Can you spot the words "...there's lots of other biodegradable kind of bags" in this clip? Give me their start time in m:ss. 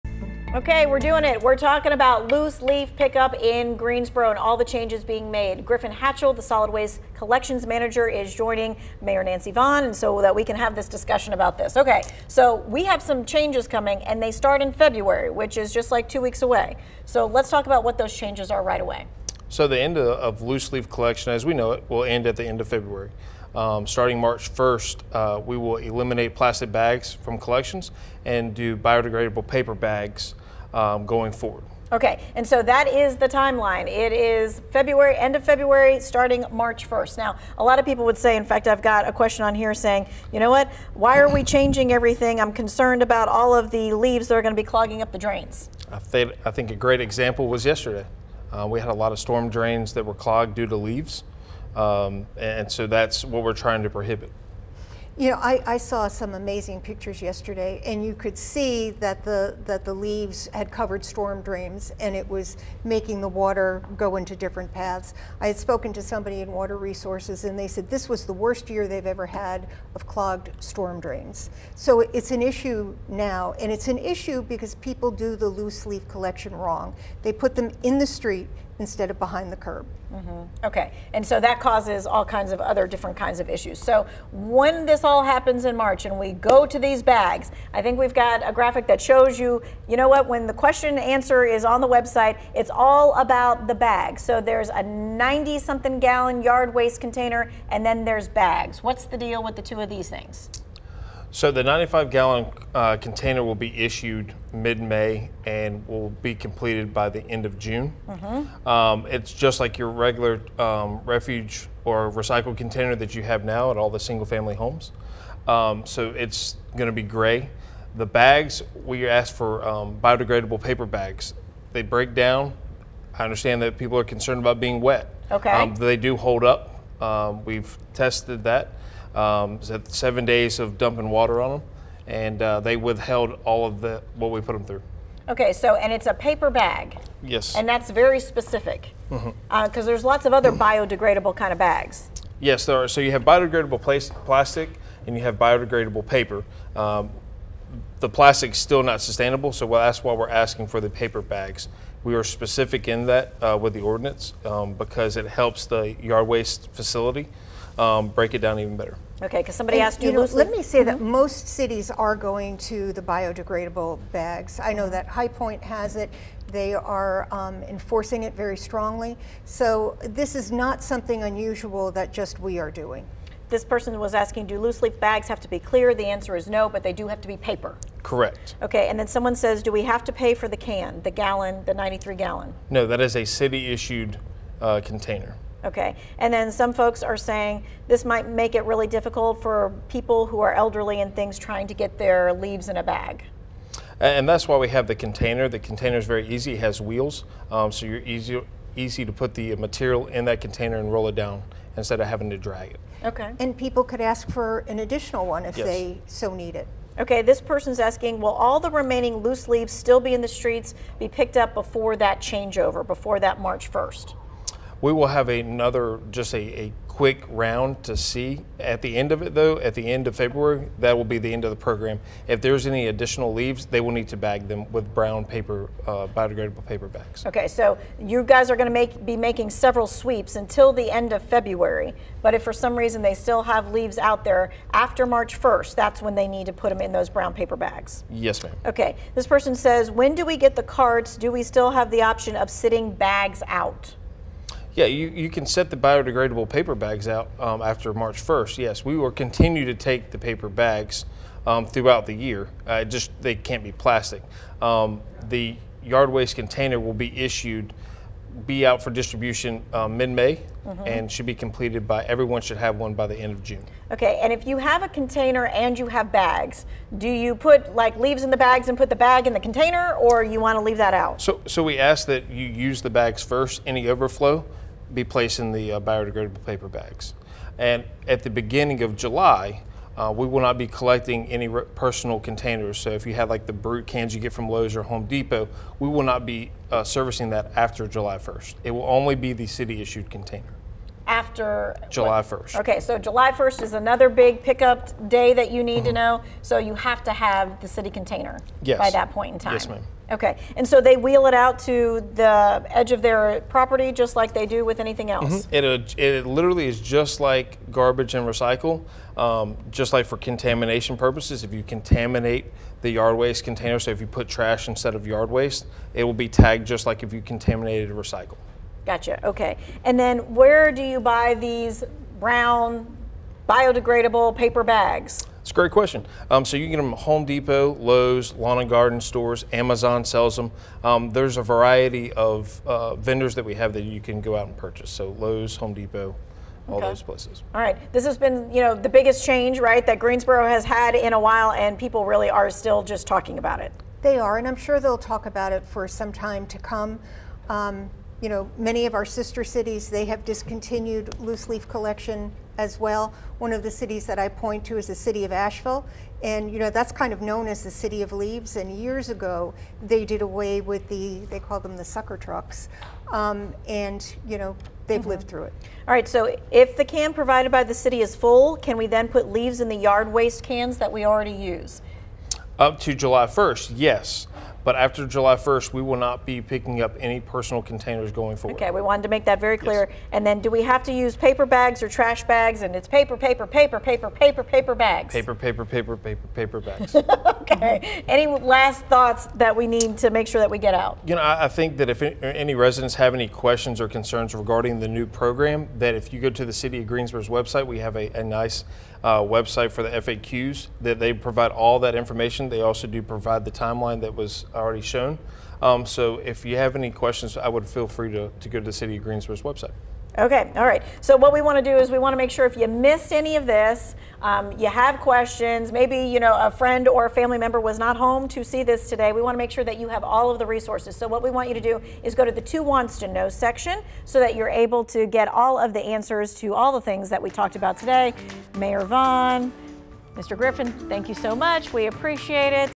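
2:19.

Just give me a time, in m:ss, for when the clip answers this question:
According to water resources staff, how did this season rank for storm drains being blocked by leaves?
1:08.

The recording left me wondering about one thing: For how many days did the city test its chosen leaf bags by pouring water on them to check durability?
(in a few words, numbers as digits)
7.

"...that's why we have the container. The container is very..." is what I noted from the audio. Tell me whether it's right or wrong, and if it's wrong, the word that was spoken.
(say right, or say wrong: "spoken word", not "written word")
right.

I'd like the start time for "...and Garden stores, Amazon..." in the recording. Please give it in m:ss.
5:28.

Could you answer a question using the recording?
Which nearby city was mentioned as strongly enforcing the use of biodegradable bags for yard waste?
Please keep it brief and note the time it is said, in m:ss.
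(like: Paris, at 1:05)
High Point, at 2:45.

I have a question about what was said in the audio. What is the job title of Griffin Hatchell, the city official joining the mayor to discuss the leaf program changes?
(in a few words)
solid waste collections manager.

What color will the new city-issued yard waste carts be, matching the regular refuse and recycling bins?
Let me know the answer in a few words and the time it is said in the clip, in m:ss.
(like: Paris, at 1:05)
gray, at 1:57.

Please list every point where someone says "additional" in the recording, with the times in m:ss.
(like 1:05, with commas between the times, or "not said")
3:24, 3:42.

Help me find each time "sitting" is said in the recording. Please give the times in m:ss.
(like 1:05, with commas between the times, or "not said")
4:02.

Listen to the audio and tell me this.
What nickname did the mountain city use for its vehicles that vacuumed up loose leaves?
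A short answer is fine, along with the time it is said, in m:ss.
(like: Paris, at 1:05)
sucker trucks, at 6:01.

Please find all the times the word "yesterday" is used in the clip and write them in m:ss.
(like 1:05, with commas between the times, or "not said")
0:47, 0:57.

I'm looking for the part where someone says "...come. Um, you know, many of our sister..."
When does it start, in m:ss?
5:46.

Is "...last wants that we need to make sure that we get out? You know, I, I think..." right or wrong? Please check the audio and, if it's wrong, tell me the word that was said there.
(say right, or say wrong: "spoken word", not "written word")
wrong: "thoughts", not "wants".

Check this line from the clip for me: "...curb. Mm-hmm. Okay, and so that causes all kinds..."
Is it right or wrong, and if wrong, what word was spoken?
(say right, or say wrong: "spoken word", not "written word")
right.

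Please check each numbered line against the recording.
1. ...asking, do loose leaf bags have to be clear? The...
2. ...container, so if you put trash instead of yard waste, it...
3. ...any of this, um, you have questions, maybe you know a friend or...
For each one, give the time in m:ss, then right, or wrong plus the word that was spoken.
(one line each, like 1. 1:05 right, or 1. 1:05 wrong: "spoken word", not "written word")
1. 2:54 right
2. 5:13 right
3. 6:53 right.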